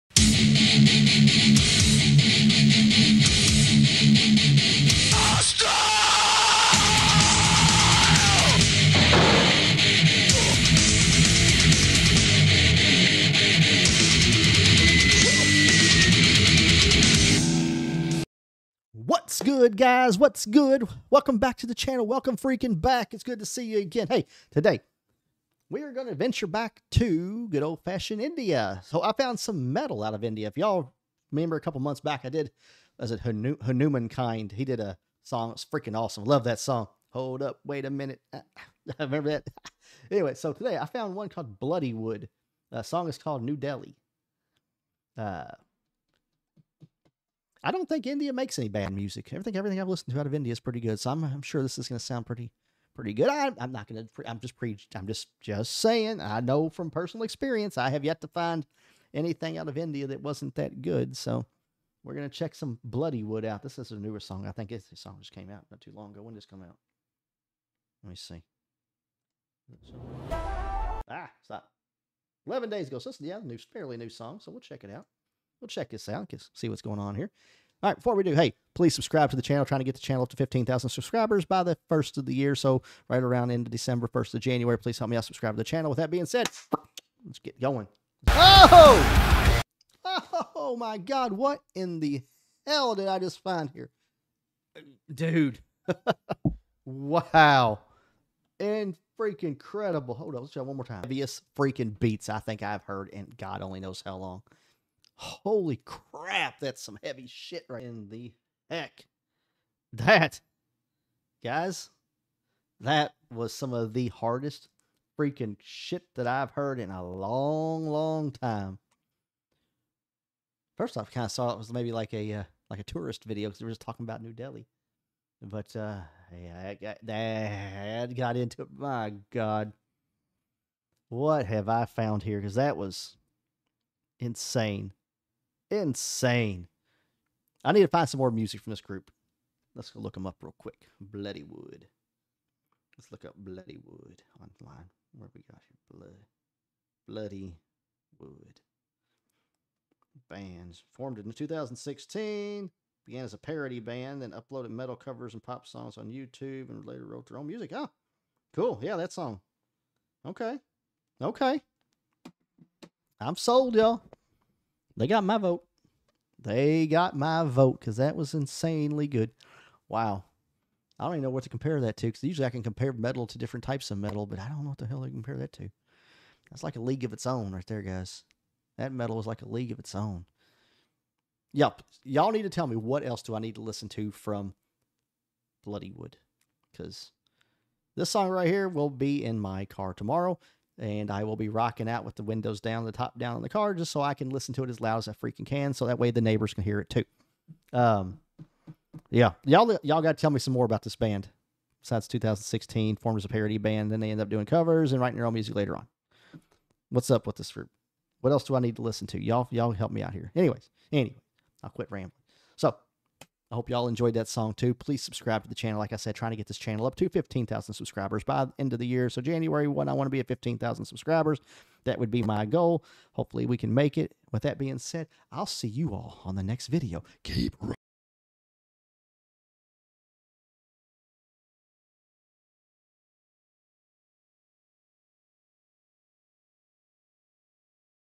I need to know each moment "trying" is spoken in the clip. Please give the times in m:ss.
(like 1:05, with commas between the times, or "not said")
1:19, 3:36.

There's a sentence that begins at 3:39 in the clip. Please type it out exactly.
So January 1, I want to be at 15,000 subscribers.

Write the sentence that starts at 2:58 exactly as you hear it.
That metal is like a league of its own.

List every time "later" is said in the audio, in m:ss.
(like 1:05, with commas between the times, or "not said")
2:36, 3:25.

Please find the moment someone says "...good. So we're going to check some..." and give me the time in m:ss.
1:00.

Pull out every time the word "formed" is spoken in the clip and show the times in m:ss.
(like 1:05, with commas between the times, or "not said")
2:30, 3:22.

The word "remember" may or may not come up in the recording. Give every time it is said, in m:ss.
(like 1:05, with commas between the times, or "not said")
0:31, 0:38.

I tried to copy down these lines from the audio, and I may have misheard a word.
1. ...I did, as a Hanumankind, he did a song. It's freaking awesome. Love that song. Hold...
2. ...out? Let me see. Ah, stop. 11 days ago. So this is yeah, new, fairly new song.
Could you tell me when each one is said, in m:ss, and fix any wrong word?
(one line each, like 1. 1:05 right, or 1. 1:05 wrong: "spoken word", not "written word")
1. 0:32 right
2. 1:06 right.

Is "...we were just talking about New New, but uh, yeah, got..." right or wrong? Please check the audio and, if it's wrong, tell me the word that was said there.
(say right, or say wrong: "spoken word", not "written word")
wrong: "Delhi", not "New".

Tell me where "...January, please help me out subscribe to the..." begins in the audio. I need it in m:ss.
1:24.